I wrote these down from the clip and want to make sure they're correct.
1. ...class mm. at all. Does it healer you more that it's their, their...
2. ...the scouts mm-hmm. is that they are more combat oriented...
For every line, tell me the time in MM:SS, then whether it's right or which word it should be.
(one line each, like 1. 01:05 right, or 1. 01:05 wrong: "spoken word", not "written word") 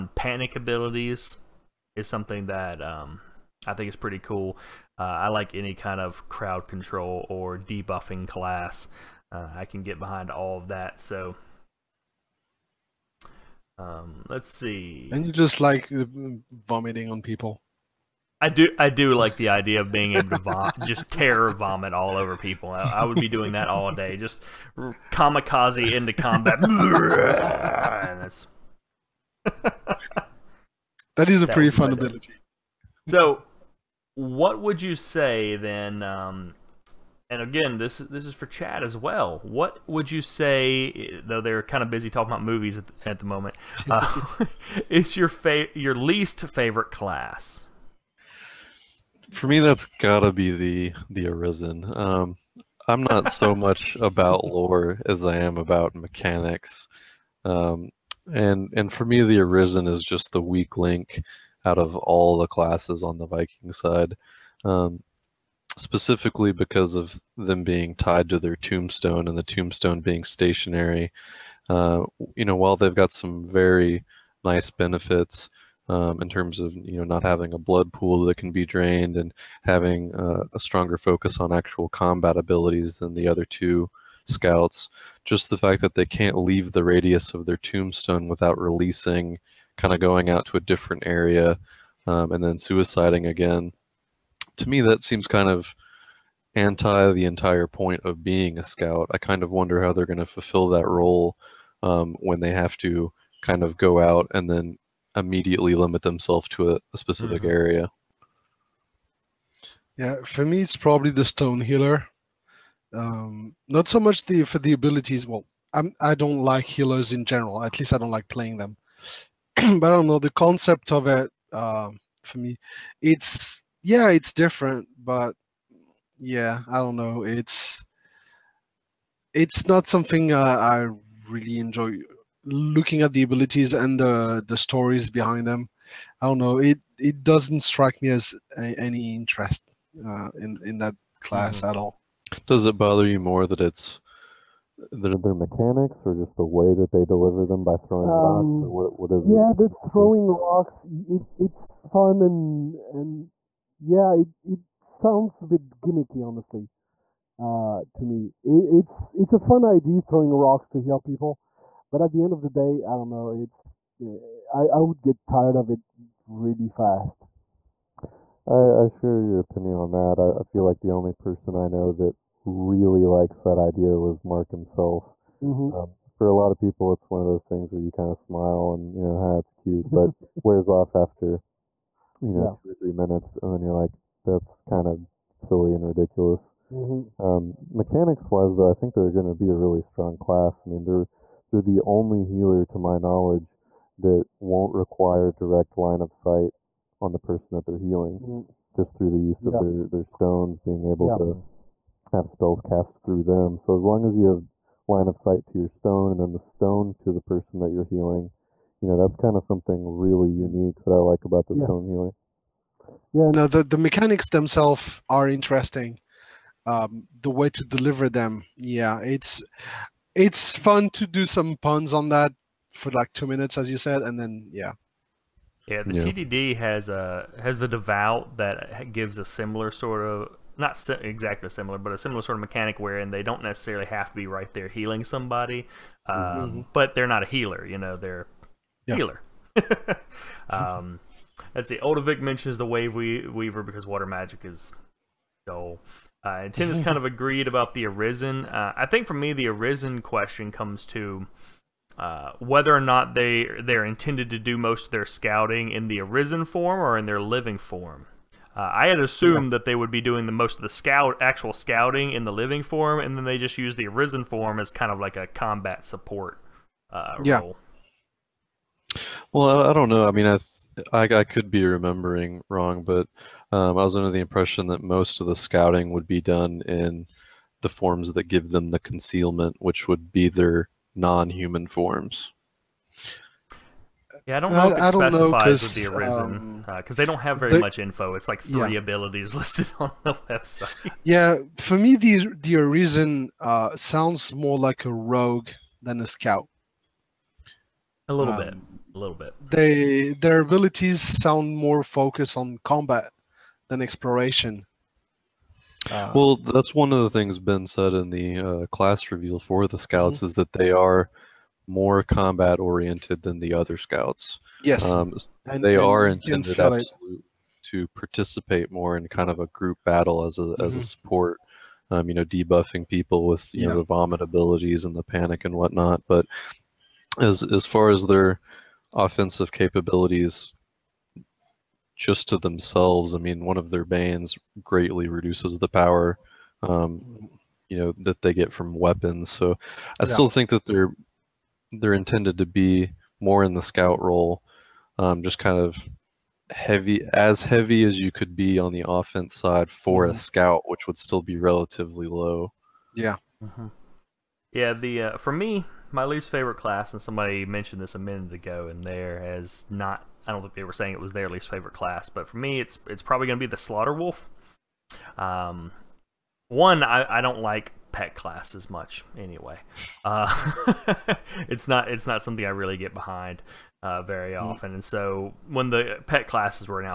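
1. 02:21 wrong: "bother", not "healer"
2. 05:09 right.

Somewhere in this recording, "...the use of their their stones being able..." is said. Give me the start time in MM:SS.
03:19.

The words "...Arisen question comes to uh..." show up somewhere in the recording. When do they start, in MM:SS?
04:09.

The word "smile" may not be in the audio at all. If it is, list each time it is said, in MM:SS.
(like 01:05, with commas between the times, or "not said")
02:58.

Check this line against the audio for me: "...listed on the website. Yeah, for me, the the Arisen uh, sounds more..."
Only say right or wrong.
right.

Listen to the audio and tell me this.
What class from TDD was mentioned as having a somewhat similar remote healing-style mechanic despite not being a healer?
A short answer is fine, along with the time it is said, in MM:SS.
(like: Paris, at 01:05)
the devout, at 03:47.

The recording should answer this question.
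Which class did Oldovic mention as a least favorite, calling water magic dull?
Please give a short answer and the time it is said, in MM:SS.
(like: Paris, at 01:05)
Wave Weaver, at 04:02.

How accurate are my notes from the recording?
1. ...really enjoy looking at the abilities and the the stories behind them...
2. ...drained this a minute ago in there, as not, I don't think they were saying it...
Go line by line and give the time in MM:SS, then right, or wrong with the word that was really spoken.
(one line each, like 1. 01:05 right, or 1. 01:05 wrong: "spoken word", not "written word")
1. 02:11 right
2. 05:57 wrong: "mentioned", not "drained".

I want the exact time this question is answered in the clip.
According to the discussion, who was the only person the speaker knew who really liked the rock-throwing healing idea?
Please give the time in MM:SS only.
02:54.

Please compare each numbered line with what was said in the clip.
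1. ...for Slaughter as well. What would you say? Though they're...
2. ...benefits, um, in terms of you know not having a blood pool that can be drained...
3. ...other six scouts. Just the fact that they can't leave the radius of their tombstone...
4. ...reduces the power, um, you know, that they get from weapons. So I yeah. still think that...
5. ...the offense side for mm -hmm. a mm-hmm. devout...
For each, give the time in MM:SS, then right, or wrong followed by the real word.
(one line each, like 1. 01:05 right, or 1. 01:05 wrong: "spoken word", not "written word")
1. 00:38 wrong: "Chad", not "Slaughter"
2. 01:14 right
3. 01:23 wrong: "two", not "six"
4. 05:35 right
5. 05:48 wrong: "scout", not "devout".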